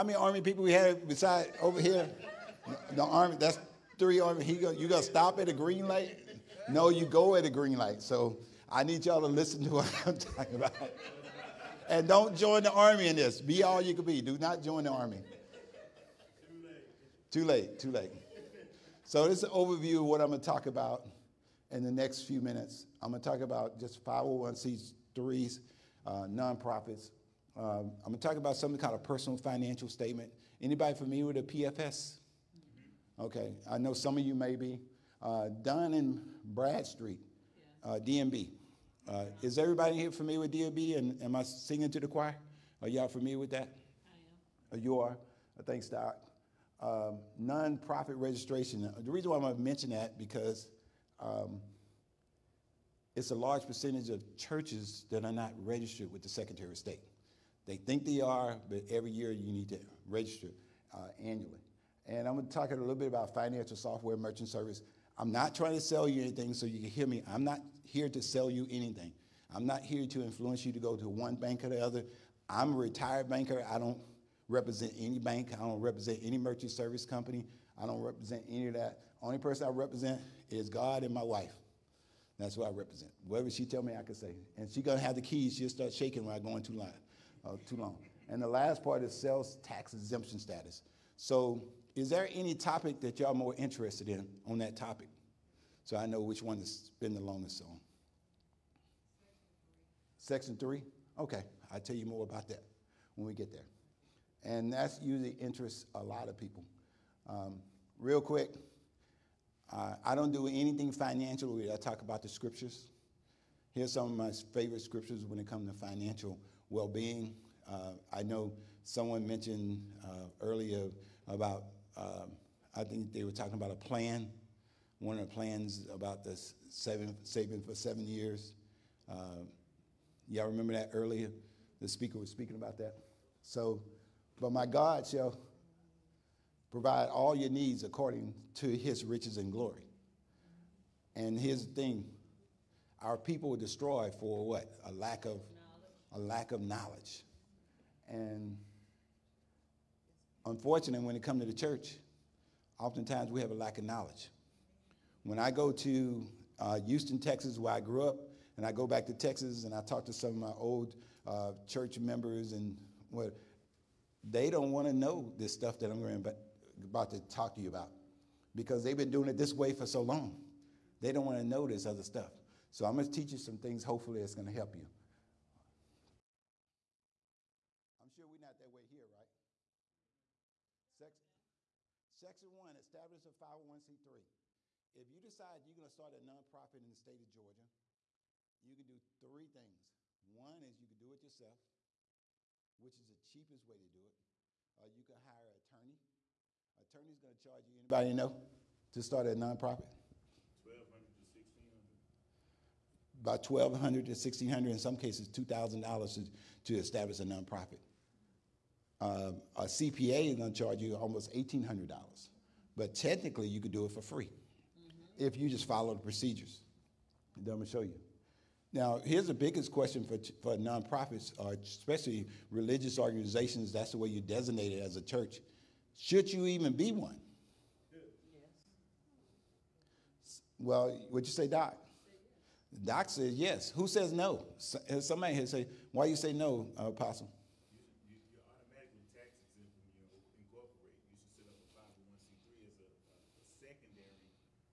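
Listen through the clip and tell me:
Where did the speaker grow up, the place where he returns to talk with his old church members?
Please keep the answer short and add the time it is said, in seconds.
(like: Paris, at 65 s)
Houston, Texas, at 156 s.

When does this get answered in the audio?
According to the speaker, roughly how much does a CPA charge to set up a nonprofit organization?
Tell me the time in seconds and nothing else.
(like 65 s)
211 s.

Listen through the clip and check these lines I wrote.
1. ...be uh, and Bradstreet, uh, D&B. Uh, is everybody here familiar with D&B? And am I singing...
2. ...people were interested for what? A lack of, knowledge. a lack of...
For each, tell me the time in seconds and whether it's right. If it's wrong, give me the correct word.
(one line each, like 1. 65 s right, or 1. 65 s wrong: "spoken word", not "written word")
1. 34 s right
2. 143 s wrong: "destroyed", not "interested".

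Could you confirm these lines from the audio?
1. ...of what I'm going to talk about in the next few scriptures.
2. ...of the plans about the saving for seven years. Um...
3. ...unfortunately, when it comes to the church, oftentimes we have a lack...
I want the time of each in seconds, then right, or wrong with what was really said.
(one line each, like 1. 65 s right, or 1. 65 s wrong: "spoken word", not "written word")
1. 19 s wrong: "minutes", not "scriptures"
2. 125 s right
3. 150 s right.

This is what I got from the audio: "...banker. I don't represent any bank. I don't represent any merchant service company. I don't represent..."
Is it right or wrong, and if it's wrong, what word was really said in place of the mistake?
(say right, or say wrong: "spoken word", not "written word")
right.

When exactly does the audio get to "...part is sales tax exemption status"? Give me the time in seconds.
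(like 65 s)
88 s.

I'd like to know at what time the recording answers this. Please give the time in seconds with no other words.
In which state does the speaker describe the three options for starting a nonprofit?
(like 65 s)
187 s.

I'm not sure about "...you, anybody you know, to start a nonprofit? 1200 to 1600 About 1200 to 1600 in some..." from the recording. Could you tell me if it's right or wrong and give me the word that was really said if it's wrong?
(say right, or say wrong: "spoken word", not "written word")
right.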